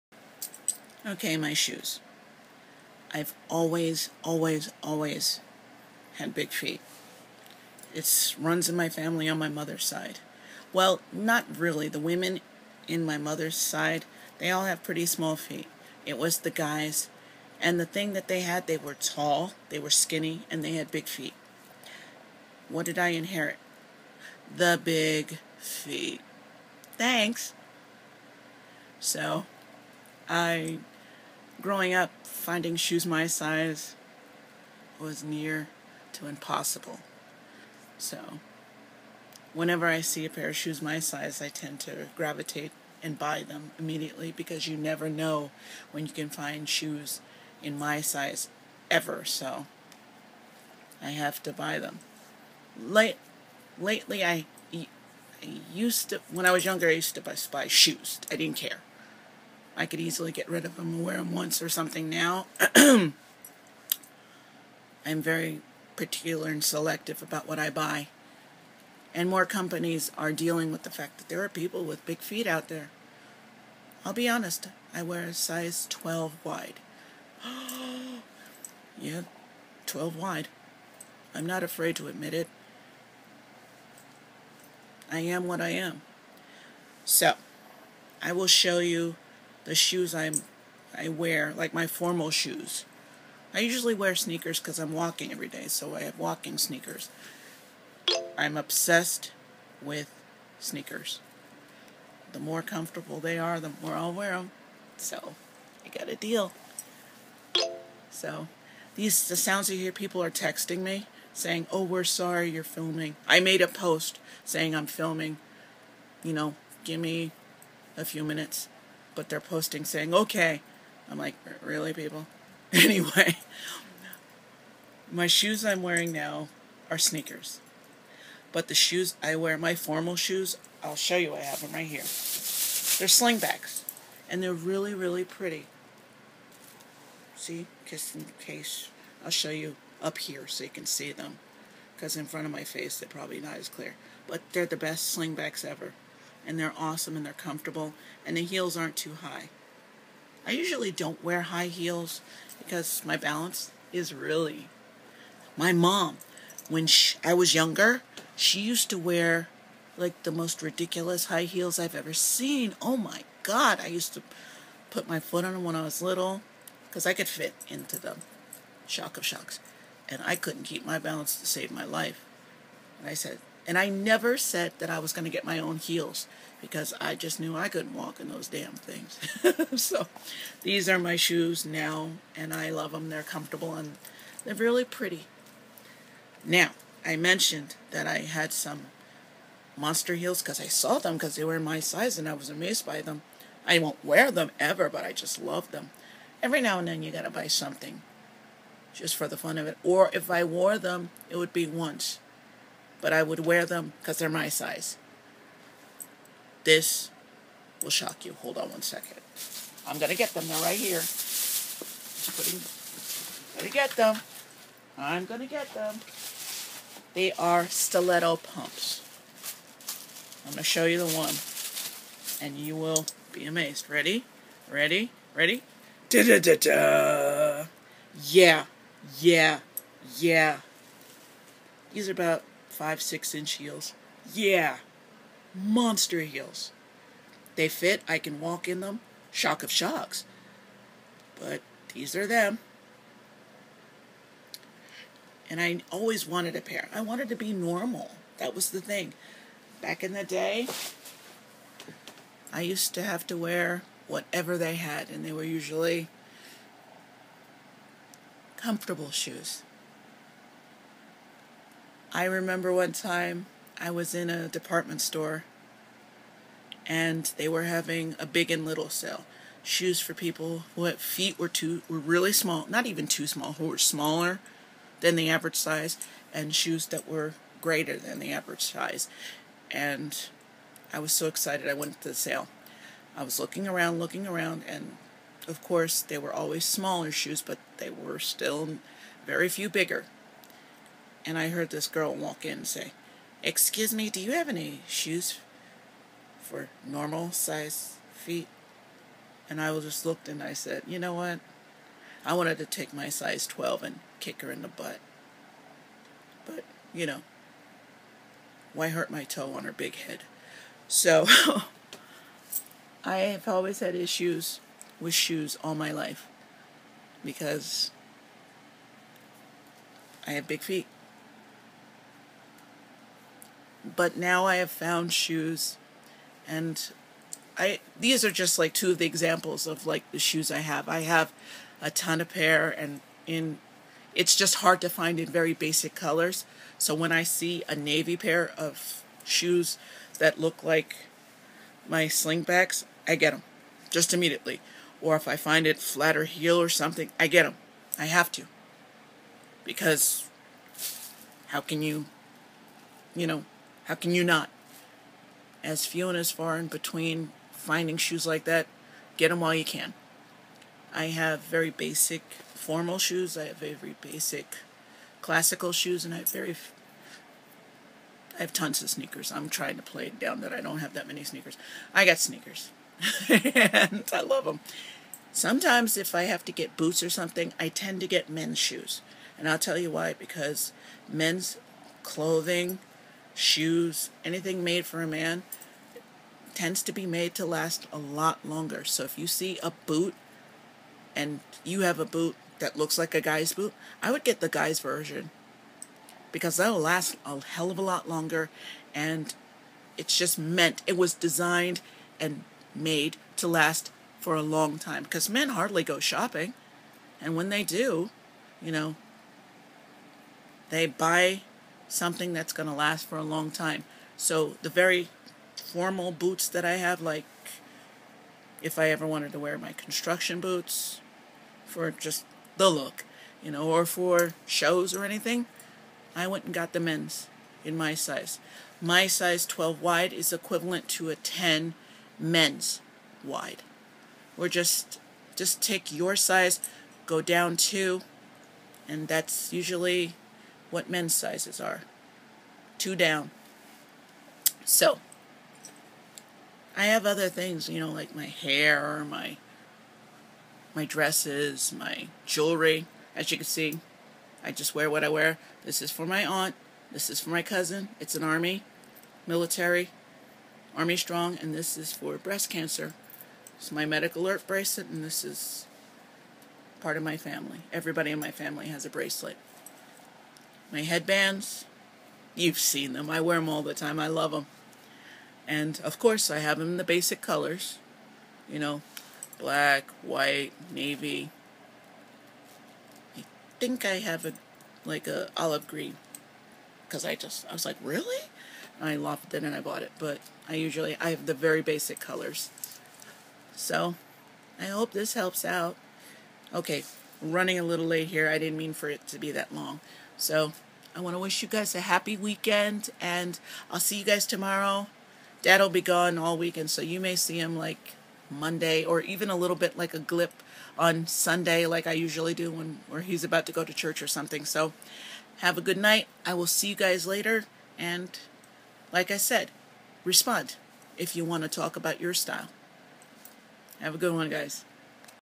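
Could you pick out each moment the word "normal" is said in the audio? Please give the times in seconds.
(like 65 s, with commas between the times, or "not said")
247 s, 296 s.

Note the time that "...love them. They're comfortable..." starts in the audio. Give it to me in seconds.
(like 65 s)
182 s.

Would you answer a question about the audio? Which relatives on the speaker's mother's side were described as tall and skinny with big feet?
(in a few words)
The guys.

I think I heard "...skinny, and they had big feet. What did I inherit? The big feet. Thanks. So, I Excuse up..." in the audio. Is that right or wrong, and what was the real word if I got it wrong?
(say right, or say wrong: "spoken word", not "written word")
wrong: "Growing", not "Excuse".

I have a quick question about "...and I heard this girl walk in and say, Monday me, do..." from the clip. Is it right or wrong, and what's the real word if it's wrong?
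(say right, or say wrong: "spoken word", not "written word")
wrong: "Excuse", not "Monday".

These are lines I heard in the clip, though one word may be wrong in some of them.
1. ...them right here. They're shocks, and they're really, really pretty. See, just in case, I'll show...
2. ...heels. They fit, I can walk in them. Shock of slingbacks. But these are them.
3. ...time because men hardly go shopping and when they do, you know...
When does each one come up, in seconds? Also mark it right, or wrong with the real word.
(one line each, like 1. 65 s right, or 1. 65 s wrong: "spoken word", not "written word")
1. 131 s wrong: "slingbacks", not "shocks"
2. 236 s wrong: "shocks", not "slingbacks"
3. 404 s right.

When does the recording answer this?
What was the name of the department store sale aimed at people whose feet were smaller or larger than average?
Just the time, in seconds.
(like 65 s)
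268 s.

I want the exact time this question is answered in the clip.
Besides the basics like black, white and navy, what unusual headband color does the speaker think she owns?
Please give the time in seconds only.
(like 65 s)
485 s.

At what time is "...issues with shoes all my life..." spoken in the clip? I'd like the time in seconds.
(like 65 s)
313 s.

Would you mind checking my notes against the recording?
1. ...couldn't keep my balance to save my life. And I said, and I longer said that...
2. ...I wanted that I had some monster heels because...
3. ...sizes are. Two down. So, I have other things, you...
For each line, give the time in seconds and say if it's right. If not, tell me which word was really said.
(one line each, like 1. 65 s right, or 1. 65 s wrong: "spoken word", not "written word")
1. 170 s wrong: "never", not "longer"
2. 187 s wrong: "mentioned", not "wanted"
3. 441 s right.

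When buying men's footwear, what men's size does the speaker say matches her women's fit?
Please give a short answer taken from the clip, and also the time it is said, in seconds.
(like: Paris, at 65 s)
10 men's wide, at 431 s.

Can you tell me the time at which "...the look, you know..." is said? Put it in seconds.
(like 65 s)
422 s.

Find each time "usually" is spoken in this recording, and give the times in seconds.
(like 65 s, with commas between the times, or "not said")
93 s, 150 s, 255 s, 439 s, 490 s, 511 s.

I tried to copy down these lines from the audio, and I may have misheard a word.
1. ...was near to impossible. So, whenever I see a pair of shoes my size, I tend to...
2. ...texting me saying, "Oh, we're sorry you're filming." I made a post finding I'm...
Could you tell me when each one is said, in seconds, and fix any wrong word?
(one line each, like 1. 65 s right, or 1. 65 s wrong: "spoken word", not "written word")
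1. 34 s right
2. 110 s wrong: "saying", not "finding".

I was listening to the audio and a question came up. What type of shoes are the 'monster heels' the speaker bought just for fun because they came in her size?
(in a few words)
Stiletto pumps.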